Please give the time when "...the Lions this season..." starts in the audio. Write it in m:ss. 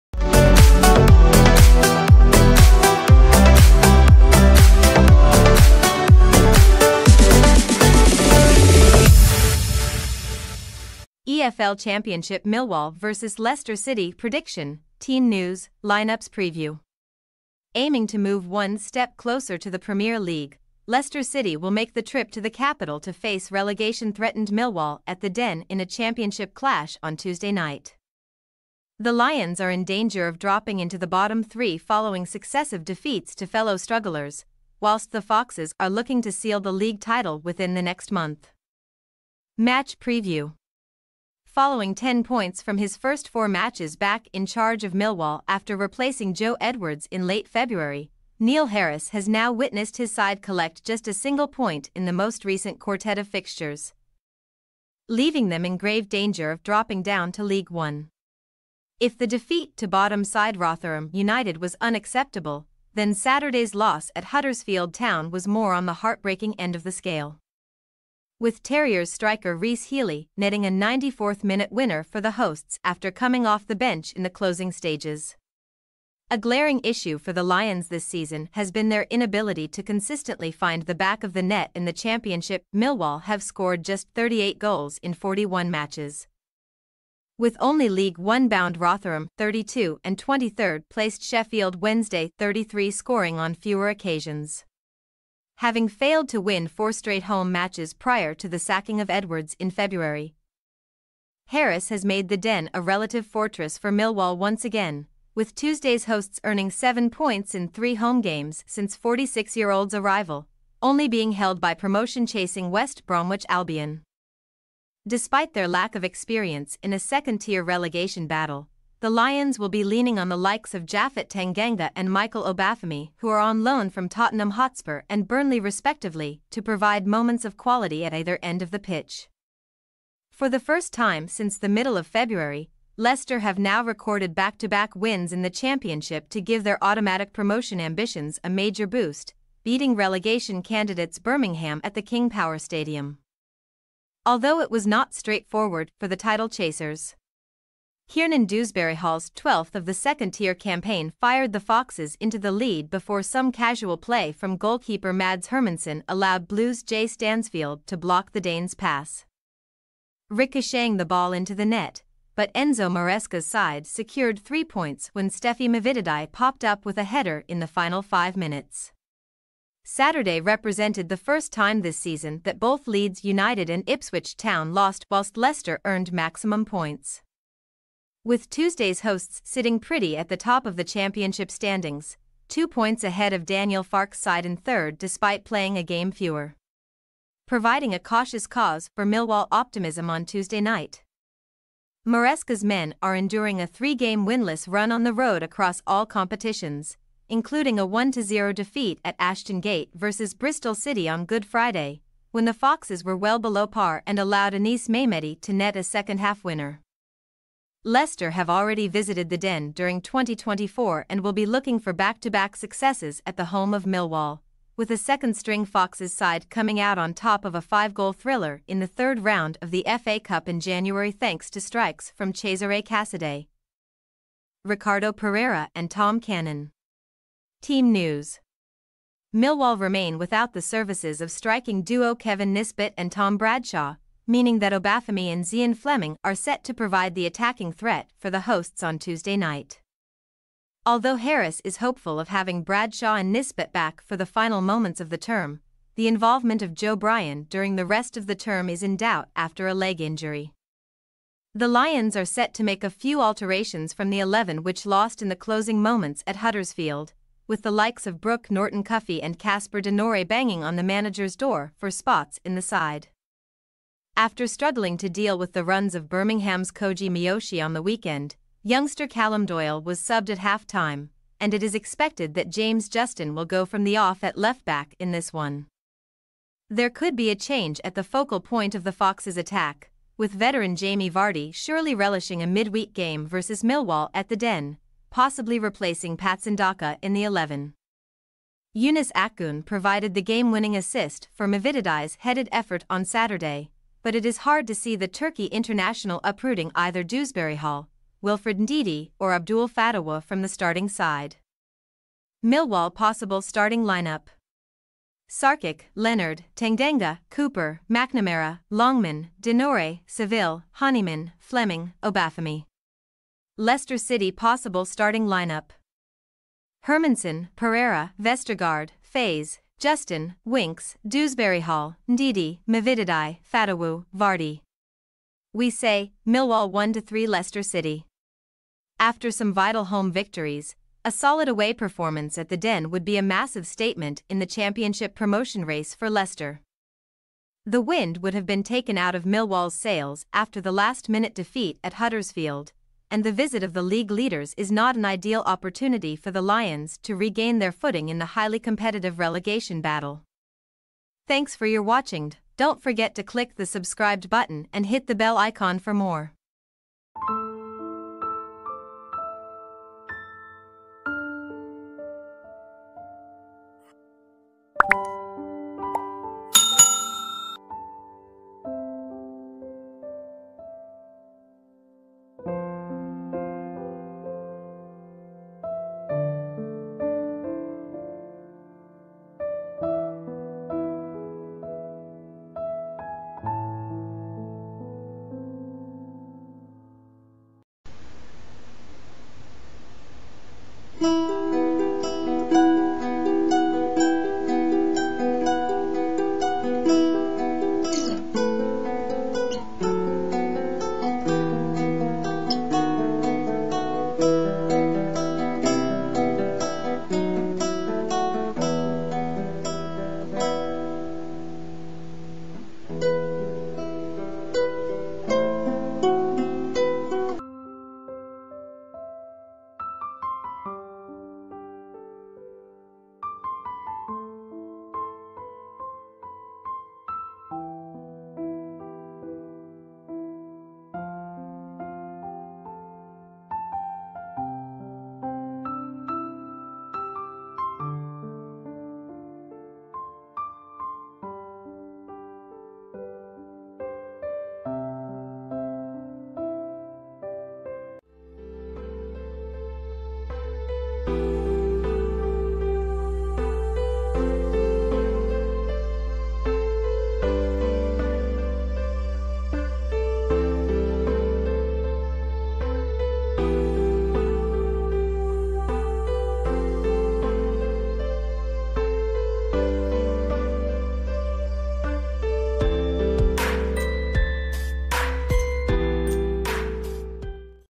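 1:17.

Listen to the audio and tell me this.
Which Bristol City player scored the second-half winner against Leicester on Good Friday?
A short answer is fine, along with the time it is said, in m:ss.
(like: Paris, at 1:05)
Anis Mehmeti, at 3:24.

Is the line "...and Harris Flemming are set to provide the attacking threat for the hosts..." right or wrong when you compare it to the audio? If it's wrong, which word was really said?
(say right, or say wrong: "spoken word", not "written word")
wrong: "Zian", not "Harris".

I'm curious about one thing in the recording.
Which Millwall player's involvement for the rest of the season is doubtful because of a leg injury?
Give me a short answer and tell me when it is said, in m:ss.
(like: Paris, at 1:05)
Joe Bryan, at 4:06.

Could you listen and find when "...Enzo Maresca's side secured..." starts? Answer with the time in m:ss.
2:42.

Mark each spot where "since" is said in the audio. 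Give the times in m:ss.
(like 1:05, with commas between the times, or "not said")
1:48, 2:11.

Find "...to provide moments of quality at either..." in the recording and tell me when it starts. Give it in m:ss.
2:06.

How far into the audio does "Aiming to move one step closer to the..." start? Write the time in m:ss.
0:17.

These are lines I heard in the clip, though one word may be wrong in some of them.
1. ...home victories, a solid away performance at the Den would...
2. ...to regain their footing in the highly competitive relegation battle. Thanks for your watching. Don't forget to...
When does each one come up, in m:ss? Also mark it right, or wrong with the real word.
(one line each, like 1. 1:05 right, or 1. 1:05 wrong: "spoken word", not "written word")
1. 5:29 right
2. 5:47 right.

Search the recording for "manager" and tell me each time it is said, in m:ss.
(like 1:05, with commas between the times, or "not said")
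4:20.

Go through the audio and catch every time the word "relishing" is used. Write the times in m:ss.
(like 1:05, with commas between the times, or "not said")
4:41.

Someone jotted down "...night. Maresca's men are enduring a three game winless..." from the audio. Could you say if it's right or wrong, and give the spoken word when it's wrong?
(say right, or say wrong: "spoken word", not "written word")
right.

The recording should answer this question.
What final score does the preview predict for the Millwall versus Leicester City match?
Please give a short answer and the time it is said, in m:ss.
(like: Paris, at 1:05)
1-3, at 5:26.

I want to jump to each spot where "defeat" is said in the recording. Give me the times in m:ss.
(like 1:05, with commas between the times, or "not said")
0:32, 0:59, 3:18, 5:41.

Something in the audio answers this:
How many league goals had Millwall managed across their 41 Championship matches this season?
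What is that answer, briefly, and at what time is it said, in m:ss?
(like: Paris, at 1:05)
38, at 1:24.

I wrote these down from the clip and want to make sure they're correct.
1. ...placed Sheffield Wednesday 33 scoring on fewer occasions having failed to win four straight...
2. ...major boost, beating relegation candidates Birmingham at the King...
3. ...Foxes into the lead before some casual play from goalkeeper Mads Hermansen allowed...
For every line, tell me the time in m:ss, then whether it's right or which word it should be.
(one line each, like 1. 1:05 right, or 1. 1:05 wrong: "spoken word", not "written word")
1. 1:30 right
2. 2:18 right
3. 2:31 right.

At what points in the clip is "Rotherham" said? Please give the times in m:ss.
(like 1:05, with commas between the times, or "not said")
1:00, 1:28.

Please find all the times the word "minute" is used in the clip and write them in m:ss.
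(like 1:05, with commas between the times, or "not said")
1:11, 2:48, 5:41.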